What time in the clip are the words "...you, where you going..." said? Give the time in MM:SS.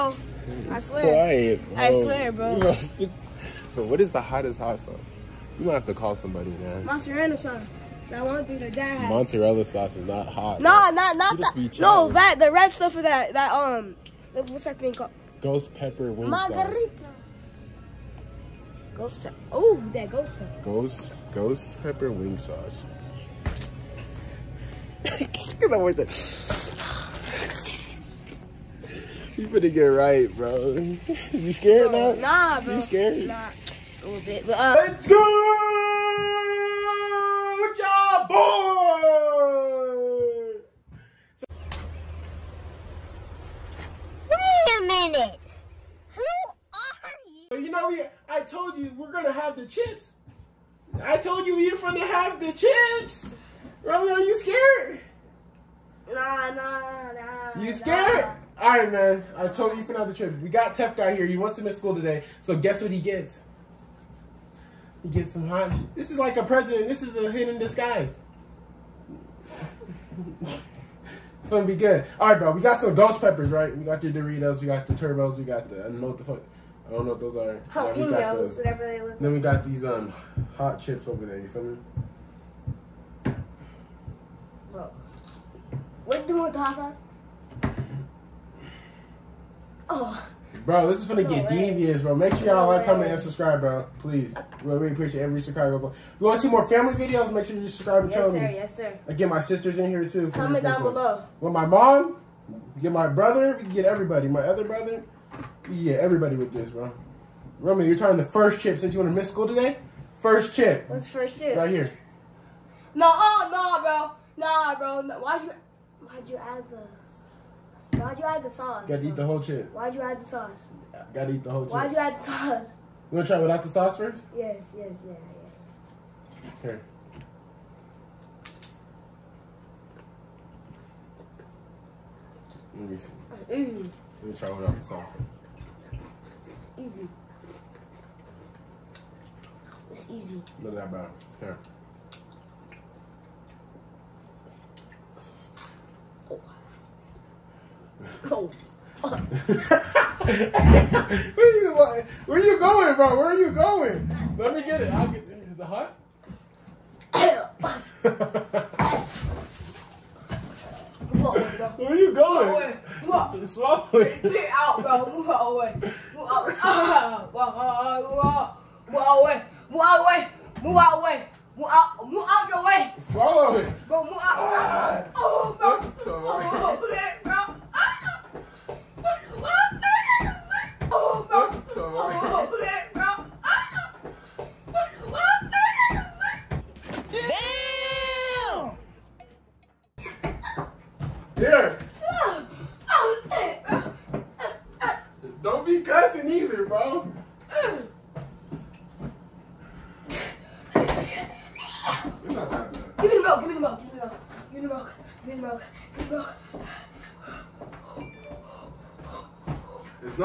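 02:31.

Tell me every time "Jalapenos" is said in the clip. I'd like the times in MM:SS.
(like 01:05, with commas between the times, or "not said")
01:17.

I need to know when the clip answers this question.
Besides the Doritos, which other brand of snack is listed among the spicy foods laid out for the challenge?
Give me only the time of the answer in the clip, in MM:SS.
01:14.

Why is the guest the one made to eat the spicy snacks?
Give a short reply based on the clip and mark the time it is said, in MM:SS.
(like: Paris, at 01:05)
He wants to miss school, at 01:01.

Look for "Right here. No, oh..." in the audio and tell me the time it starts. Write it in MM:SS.
01:51.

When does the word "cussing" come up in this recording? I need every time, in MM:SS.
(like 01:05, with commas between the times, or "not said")
03:15.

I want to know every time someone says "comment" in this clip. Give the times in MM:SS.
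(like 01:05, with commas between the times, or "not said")
01:32, 01:40.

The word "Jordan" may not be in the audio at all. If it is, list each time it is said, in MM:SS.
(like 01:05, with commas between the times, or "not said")
not said.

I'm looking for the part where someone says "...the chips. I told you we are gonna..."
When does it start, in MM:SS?
00:49.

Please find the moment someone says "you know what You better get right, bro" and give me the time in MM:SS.
00:25.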